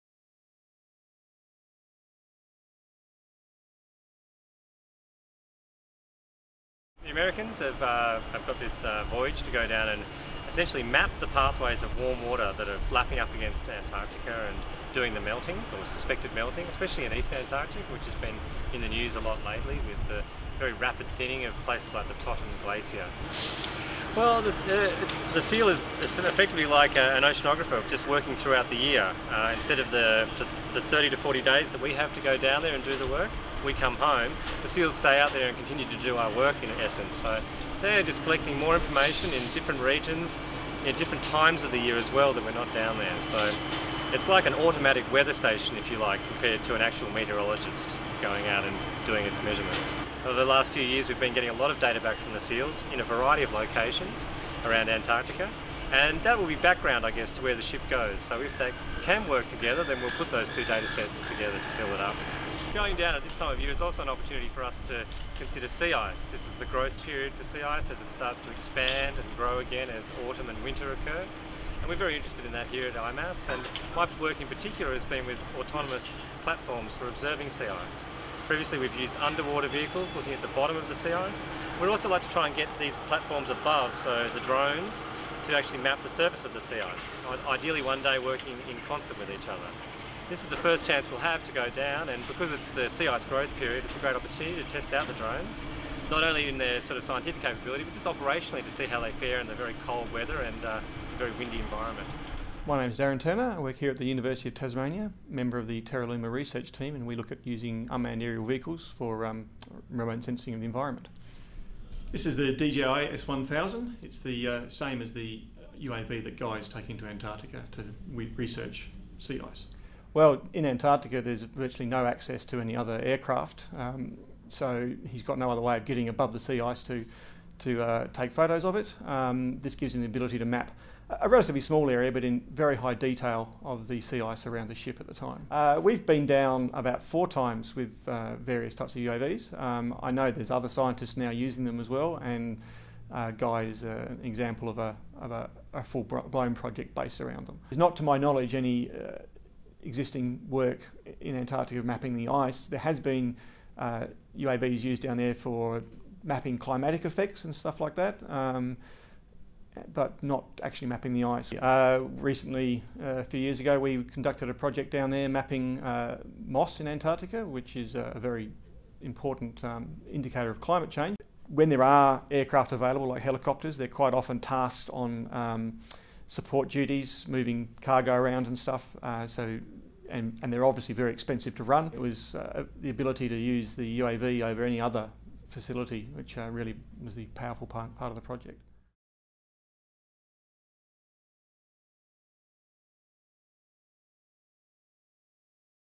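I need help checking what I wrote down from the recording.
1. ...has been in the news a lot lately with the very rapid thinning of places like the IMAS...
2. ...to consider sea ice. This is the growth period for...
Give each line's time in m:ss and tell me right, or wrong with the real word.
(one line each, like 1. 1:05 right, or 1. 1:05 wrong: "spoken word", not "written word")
1. 0:18 wrong: "Totten", not "IMAS"
2. 1:04 right.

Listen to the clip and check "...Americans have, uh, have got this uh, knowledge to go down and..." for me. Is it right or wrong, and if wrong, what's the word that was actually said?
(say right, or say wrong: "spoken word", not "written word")
wrong: "voyage", not "knowledge".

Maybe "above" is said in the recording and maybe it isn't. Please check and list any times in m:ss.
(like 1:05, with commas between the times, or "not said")
1:23, 2:06.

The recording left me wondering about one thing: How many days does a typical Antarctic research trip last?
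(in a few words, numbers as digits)
30 to 40 days.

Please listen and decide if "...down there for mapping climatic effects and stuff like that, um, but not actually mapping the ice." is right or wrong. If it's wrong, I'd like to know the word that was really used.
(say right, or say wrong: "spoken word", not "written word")
right.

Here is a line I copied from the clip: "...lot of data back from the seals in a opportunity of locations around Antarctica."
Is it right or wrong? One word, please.
wrong.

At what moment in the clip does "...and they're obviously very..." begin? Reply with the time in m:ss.
3:00.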